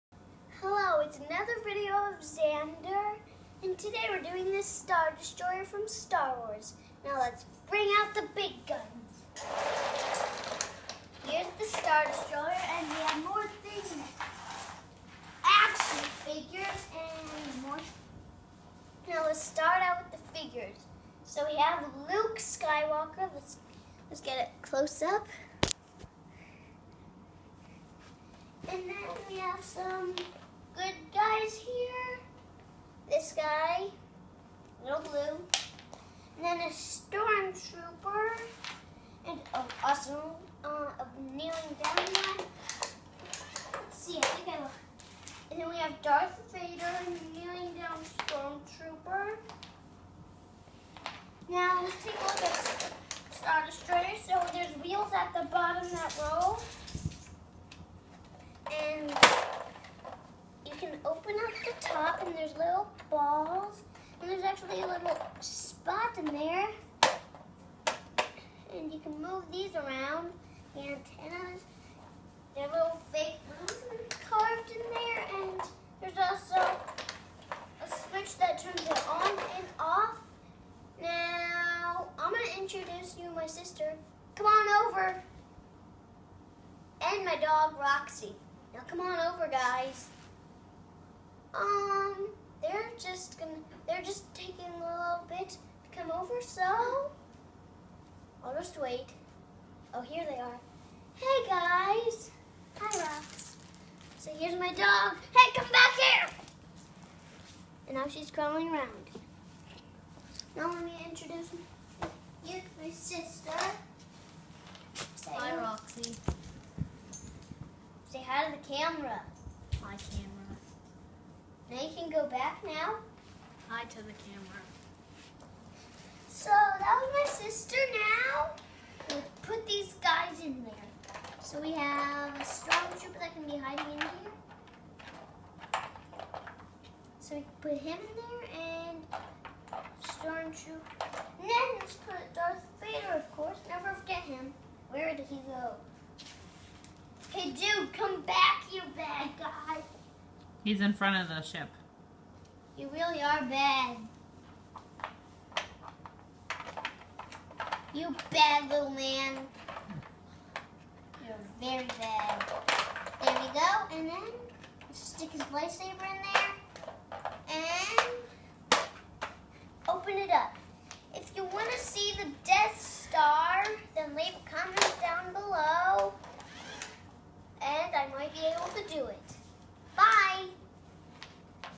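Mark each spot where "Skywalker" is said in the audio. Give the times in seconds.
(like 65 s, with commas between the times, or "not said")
22 s.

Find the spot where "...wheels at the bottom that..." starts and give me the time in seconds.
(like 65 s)
54 s.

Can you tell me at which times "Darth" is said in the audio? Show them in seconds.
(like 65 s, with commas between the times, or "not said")
46 s, 142 s.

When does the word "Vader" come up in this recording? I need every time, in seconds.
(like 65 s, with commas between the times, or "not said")
46 s, 142 s.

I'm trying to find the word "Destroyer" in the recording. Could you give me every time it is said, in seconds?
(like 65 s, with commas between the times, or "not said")
5 s, 12 s, 53 s.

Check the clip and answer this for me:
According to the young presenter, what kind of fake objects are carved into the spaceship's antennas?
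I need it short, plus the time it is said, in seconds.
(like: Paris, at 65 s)
Balloons, at 72 s.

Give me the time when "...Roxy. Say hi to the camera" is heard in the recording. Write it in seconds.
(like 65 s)
115 s.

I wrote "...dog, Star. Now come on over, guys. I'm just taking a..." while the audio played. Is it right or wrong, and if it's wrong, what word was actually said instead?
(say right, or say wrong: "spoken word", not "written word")
wrong: "Roxy", not "Star".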